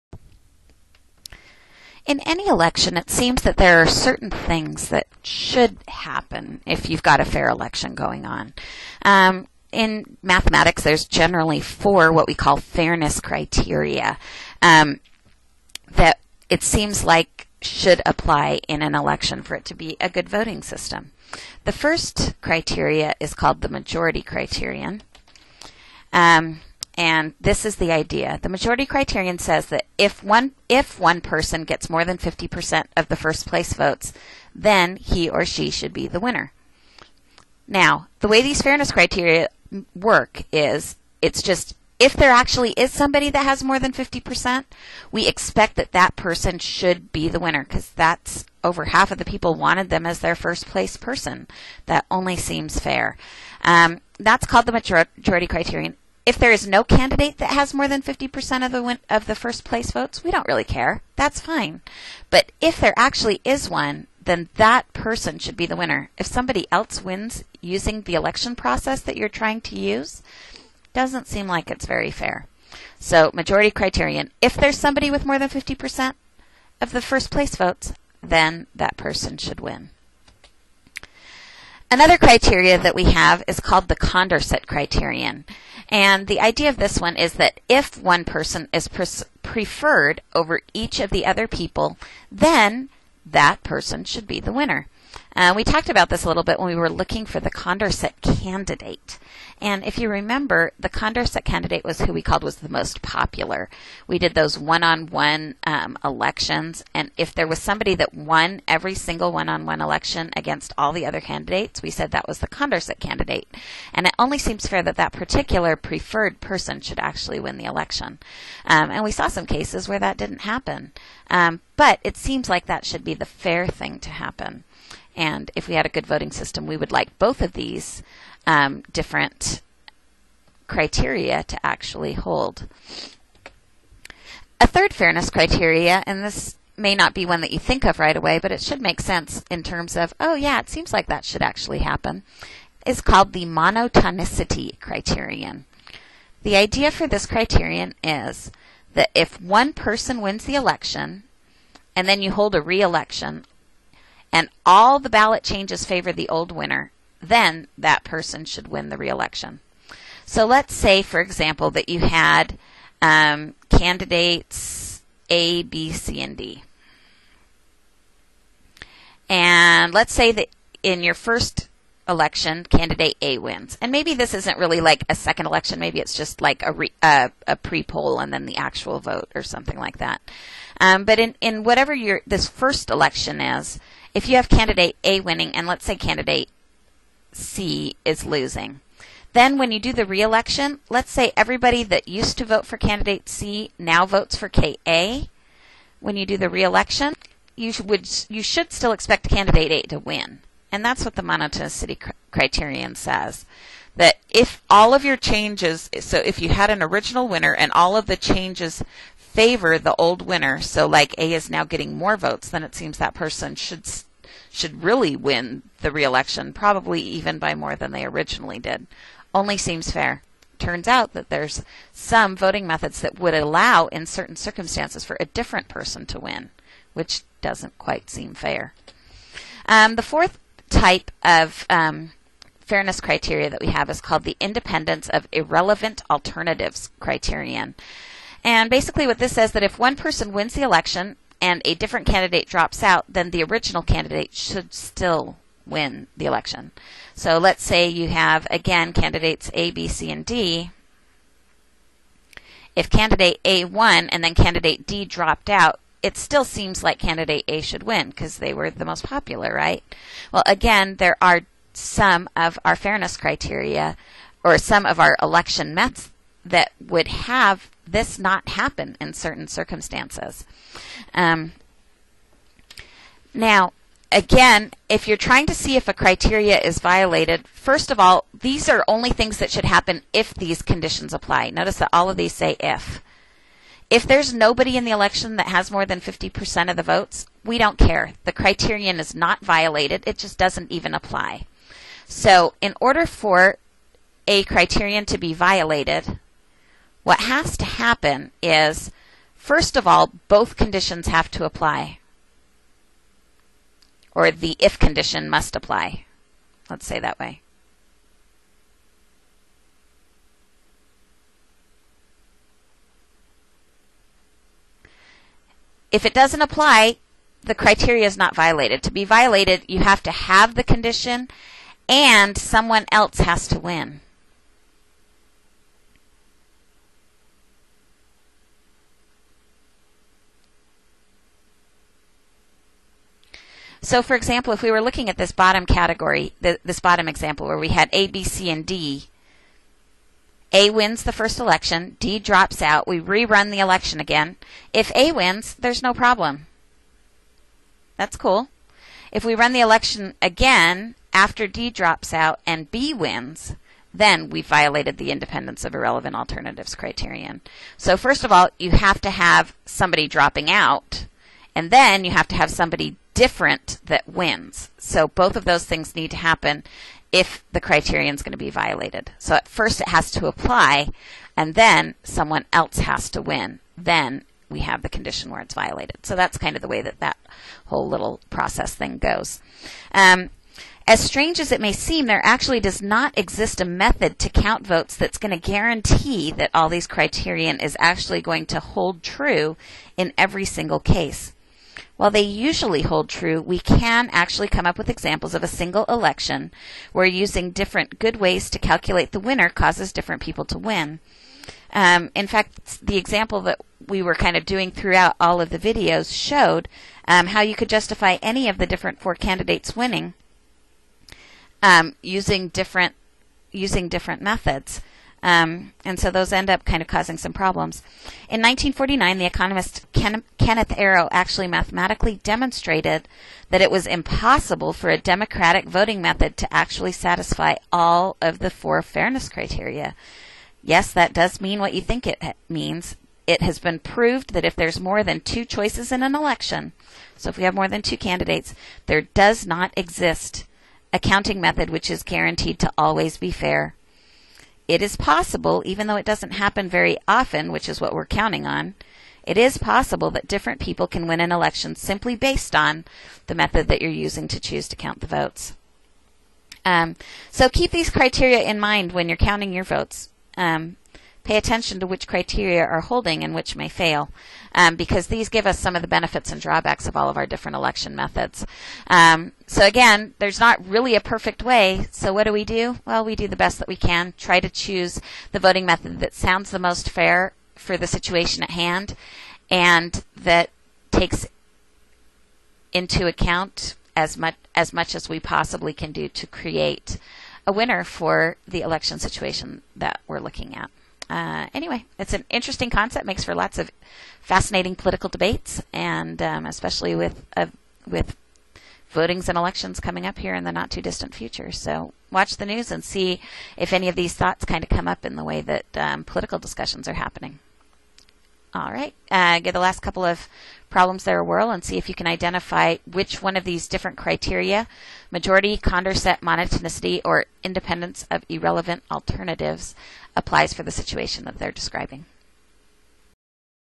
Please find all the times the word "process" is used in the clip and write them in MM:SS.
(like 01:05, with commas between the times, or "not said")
01:08, 06:18.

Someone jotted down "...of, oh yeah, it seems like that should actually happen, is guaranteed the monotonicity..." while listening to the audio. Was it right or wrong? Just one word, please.
wrong.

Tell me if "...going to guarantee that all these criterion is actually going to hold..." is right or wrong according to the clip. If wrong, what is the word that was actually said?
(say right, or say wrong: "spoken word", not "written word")
right.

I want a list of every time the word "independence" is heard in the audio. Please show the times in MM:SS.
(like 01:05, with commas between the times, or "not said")
03:54, 05:55, 08:37.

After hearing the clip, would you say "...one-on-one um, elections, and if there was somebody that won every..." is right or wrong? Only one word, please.
right.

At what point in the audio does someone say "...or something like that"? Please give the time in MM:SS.
02:59.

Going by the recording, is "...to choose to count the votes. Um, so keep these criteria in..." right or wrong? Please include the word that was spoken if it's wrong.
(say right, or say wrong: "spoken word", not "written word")
right.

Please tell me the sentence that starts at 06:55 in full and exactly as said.
Um, and so those end up kind of causing some problems.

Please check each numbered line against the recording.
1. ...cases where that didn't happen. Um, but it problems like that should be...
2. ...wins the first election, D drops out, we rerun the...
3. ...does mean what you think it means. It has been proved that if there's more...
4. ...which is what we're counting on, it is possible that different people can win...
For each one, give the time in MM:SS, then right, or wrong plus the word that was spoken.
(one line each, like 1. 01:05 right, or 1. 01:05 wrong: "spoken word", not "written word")
1. 01:59 wrong: "seems", not "problems"
2. 05:40 right
3. 07:11 right
4. 07:27 right.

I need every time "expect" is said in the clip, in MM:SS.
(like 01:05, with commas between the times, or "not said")
00:45, 03:18.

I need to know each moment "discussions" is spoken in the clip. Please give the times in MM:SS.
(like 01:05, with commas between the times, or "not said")
08:26.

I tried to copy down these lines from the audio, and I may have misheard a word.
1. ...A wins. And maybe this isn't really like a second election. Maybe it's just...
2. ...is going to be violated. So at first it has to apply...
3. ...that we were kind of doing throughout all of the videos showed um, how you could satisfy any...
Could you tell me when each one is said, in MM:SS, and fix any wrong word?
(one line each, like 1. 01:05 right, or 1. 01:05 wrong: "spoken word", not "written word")
1. 02:53 right
2. 06:08 right
3. 06:43 wrong: "justify", not "satisfy".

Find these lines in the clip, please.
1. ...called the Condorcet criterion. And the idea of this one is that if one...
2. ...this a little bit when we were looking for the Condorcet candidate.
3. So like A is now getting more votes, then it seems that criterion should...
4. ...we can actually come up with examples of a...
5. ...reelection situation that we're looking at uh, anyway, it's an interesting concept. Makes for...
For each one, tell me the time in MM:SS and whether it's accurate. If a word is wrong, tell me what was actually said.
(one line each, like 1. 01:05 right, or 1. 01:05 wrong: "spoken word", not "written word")
1. 01:23 right
2. 01:36 right
3. 03:30 wrong: "person", not "criterion"
4. 06:33 right
5. 08:08 wrong: "election", not "reelection".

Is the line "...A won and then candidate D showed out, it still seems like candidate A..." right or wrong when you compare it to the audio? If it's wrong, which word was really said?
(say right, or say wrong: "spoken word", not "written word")
wrong: "dropped", not "showed".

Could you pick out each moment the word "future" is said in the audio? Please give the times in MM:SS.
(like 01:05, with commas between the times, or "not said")
08:21.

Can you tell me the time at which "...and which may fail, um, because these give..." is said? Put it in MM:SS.
07:43.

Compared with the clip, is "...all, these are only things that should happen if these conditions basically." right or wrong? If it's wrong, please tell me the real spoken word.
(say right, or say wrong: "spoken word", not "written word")
wrong: "apply", not "basically".